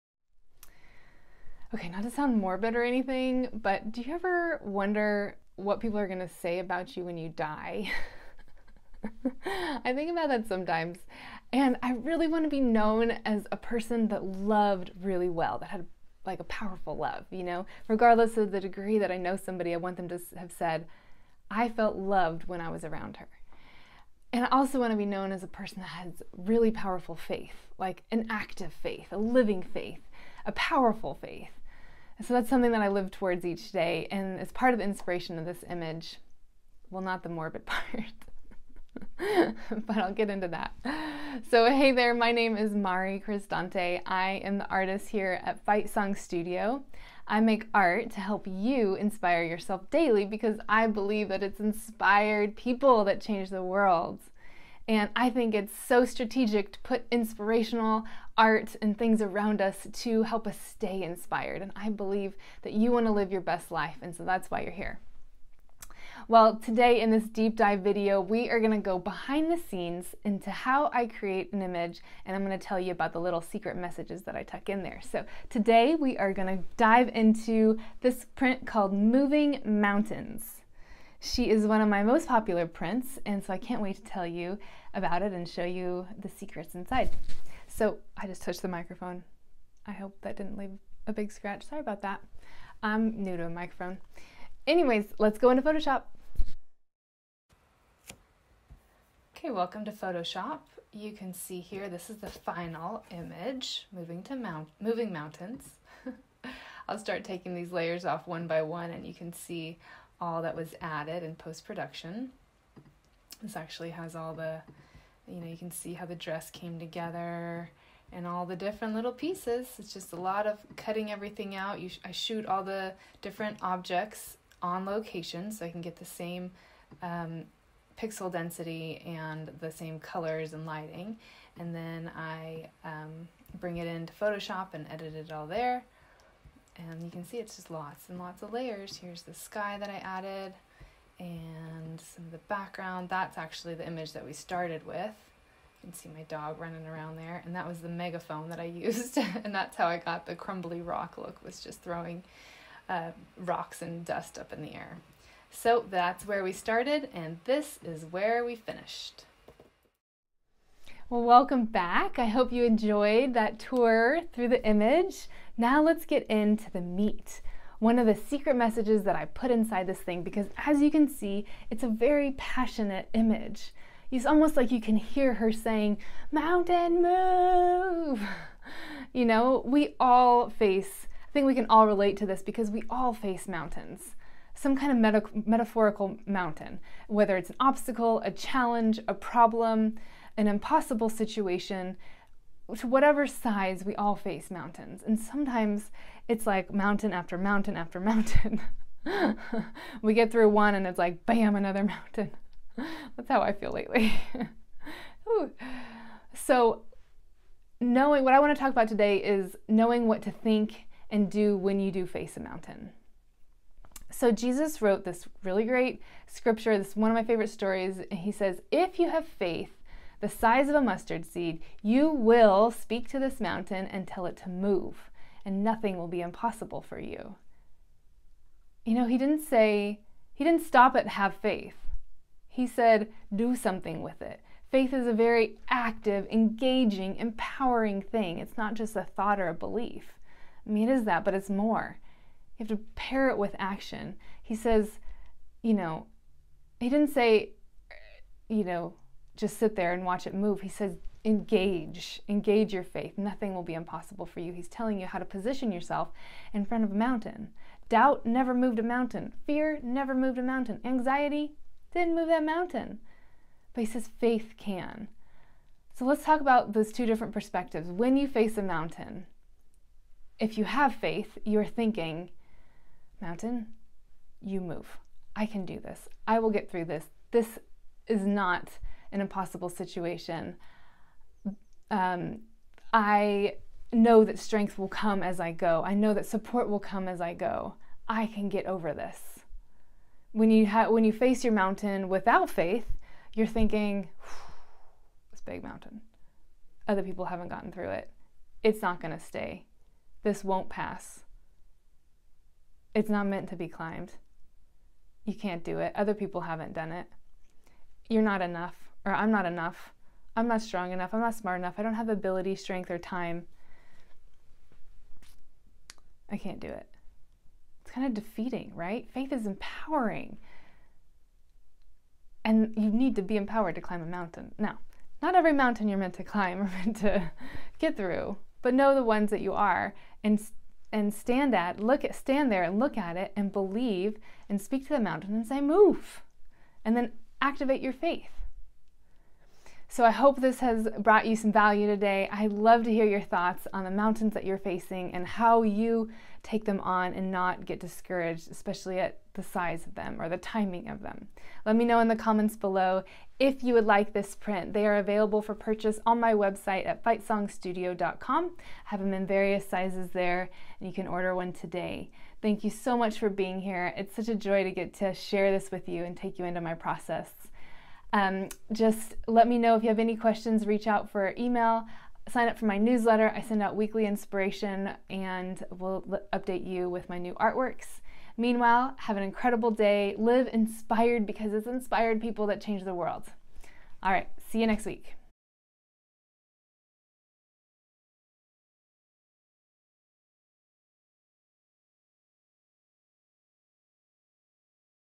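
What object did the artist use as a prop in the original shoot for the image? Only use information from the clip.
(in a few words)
Megaphone.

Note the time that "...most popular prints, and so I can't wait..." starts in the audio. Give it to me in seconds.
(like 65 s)
82 s.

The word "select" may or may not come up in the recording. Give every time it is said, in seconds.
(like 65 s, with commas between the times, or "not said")
not said.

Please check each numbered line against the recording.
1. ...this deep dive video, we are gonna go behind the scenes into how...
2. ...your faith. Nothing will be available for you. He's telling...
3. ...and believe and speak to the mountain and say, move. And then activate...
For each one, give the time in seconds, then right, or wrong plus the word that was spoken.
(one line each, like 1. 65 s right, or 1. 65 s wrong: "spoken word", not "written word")
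1. 67 s right
2. 252 s wrong: "impossible", not "available"
3. 333 s right.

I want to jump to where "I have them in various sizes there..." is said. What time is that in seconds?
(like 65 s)
358 s.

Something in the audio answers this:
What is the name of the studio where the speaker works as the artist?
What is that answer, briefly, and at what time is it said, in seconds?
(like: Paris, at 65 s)
Fightsong Studio, at 45 s.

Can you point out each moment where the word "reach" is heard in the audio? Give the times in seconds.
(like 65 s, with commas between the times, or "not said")
370 s.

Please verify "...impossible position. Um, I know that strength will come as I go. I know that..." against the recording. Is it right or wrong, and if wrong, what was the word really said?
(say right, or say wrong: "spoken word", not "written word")
wrong: "situation", not "position".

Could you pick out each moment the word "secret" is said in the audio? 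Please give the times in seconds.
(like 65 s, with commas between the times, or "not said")
73 s, 86 s, 168 s.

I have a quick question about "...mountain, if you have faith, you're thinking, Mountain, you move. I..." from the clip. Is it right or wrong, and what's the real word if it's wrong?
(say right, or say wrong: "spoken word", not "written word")
right.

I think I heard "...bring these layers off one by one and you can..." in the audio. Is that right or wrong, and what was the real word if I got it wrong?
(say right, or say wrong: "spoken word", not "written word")
wrong: "taking", not "bring".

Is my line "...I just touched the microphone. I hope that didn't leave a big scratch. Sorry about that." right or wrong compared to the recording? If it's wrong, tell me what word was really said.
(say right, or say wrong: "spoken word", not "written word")
right.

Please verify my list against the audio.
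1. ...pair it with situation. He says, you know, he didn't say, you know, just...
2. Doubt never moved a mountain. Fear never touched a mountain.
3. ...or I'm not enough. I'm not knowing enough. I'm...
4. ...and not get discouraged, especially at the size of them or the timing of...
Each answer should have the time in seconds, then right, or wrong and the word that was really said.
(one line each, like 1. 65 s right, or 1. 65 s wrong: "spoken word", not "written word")
1. 242 s wrong: "action", not "situation"
2. 257 s wrong: "moved", not "touched"
3. 309 s wrong: "strong", not "knowing"
4. 347 s right.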